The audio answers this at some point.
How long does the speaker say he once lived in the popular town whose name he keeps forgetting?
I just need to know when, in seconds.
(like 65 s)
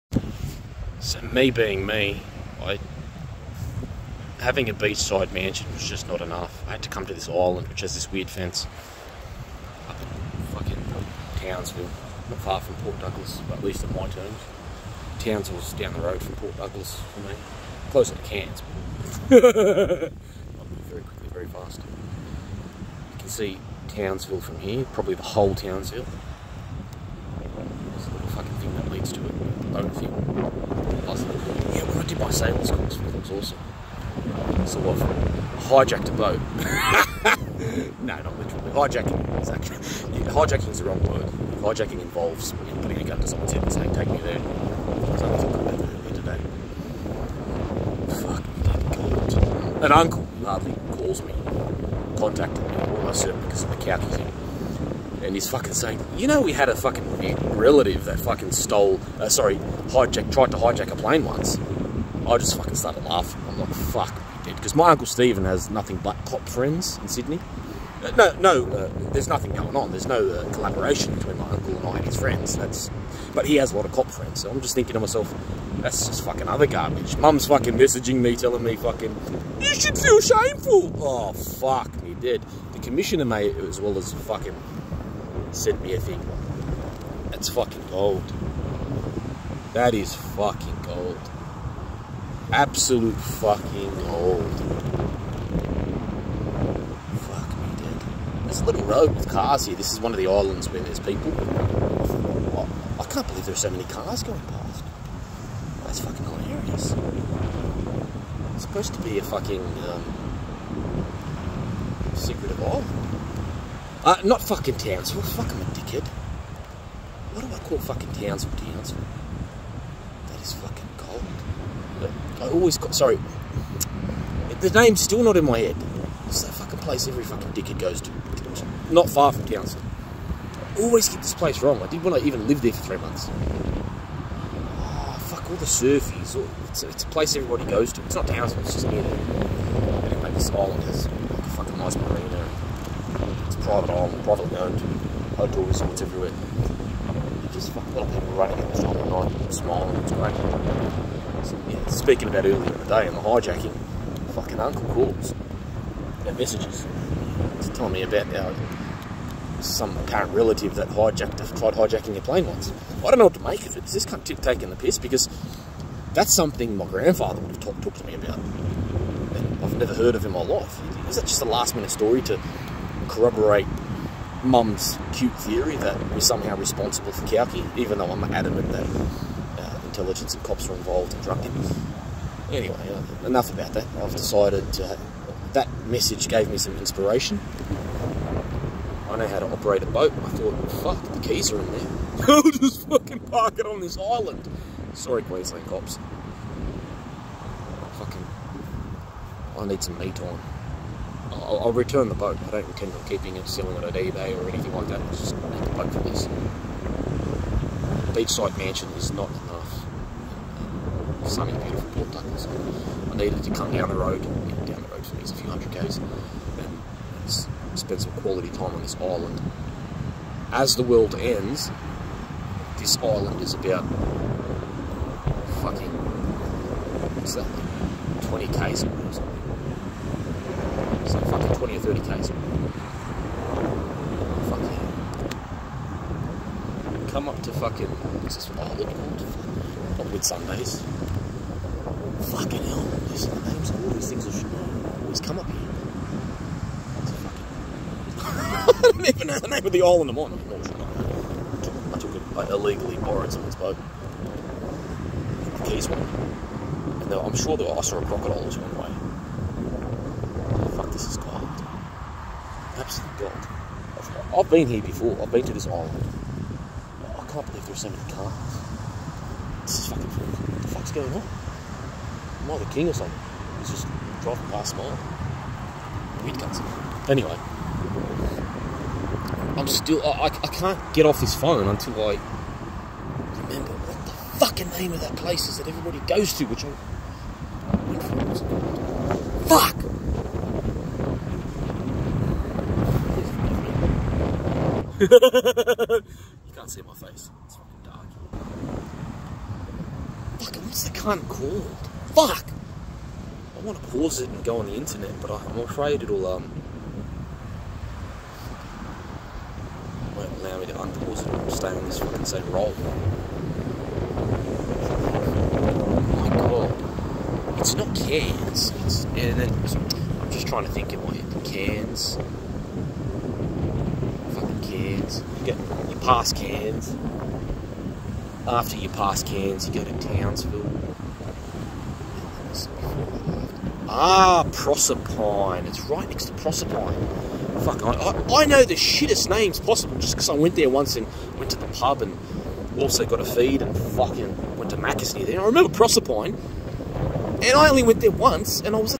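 132 s.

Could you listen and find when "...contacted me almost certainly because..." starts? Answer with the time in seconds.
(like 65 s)
52 s.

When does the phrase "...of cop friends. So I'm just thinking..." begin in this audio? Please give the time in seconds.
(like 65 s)
73 s.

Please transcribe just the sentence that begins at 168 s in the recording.
And I've never heard of in my life.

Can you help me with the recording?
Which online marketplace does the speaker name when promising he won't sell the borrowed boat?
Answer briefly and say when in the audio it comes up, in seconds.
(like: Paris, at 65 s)
eBay, at 203 s.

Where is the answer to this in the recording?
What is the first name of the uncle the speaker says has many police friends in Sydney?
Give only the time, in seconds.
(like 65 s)
65 s.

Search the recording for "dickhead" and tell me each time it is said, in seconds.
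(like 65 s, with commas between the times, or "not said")
115 s, 127 s.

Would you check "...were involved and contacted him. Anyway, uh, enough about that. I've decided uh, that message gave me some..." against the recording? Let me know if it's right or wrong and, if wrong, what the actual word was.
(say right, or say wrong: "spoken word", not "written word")
wrong: "drugged", not "contacted".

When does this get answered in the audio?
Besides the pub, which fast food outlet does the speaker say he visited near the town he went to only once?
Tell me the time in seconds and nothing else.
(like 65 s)
344 s.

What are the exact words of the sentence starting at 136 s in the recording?
it's, a, it's, a place everybody goes to.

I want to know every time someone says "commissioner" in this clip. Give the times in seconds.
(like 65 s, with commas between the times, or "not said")
82 s.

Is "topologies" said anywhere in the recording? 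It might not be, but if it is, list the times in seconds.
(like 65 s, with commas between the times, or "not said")
not said.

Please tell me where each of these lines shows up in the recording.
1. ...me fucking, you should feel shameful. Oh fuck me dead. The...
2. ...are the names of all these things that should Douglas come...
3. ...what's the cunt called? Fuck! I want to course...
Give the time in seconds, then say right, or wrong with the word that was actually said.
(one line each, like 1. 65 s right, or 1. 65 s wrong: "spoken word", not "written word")
1. 78 s right
2. 243 s wrong: "Always", not "Douglas"
3. 300 s wrong: "pause", not "course".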